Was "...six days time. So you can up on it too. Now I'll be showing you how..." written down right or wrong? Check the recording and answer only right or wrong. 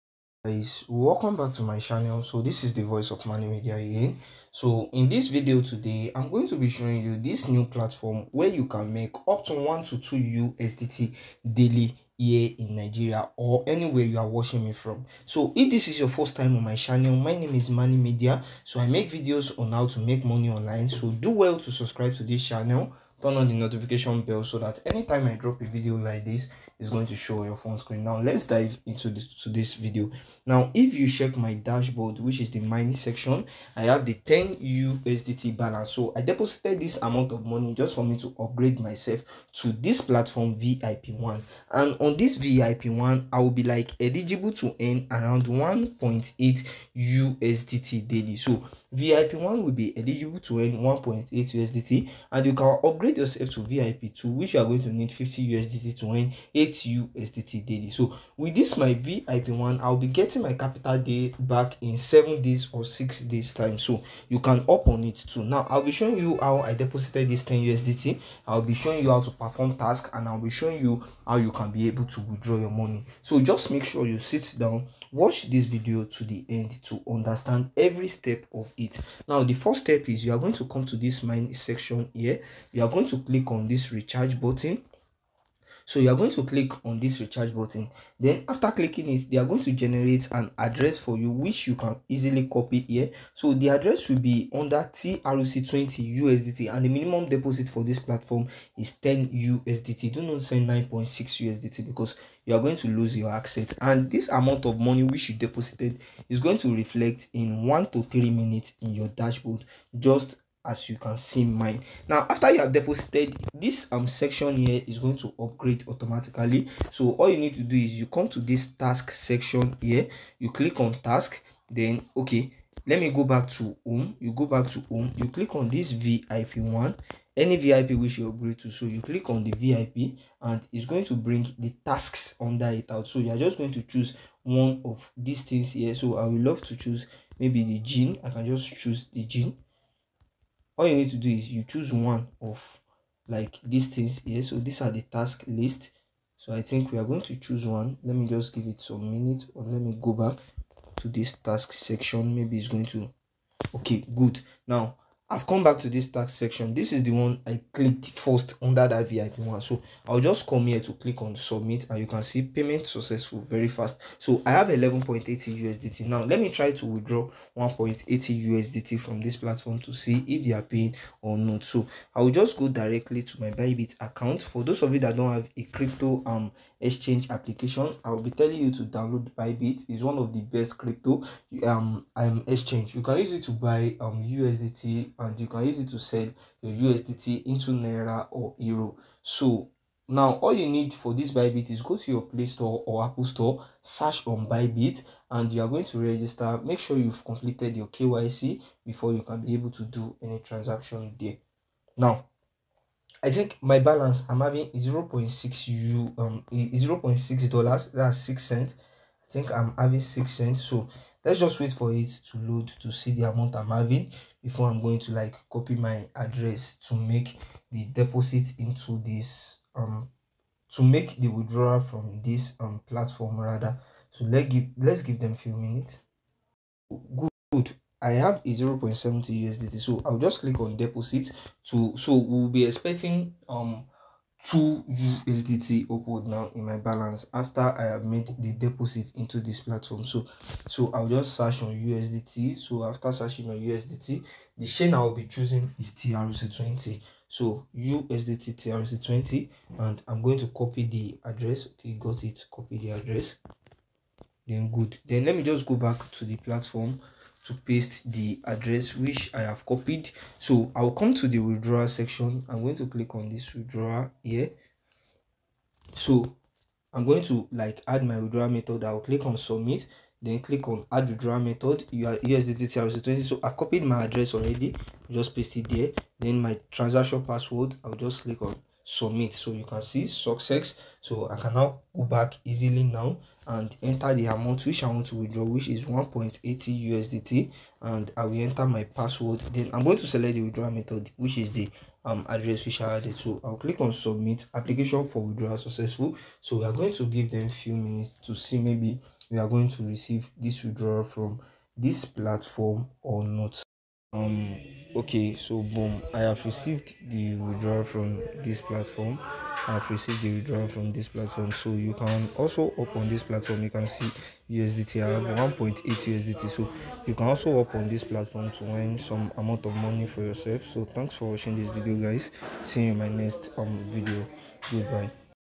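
right.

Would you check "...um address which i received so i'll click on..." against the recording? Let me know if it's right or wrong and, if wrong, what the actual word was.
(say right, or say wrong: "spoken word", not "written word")
wrong: "added", not "received".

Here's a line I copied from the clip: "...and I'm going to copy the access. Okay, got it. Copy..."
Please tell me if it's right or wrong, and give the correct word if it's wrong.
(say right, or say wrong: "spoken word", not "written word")
wrong: "address", not "access".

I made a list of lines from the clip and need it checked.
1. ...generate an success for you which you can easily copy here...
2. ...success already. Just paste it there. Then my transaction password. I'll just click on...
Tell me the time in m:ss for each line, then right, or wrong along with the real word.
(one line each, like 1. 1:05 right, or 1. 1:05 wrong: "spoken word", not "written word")
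1. 1:29 wrong: "address", not "success"
2. 4:34 wrong: "address", not "success".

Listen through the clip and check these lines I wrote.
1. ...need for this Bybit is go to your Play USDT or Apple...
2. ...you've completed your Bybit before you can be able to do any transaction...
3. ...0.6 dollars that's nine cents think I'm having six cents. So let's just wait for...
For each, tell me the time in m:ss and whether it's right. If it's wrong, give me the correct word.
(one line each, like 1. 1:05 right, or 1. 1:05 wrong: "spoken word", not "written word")
1. 3:10 wrong: "Store", not "USDT"
2. 3:16 wrong: "KYC", not "Bybit"
3. 3:26 wrong: "six", not "nine".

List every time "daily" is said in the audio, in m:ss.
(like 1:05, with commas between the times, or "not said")
0:11, 0:48, 0:57.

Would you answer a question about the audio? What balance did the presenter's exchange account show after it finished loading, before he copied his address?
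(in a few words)
0.70 USDT.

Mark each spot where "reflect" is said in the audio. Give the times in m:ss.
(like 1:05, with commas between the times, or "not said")
1:46.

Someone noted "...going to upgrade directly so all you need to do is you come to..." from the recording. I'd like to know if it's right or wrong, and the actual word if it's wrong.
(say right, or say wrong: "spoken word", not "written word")
wrong: "automatically", not "directly".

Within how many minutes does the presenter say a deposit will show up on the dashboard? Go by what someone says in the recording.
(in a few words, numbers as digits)
1 to 3 minutes.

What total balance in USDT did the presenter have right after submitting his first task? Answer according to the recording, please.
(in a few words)
11.80 USDT.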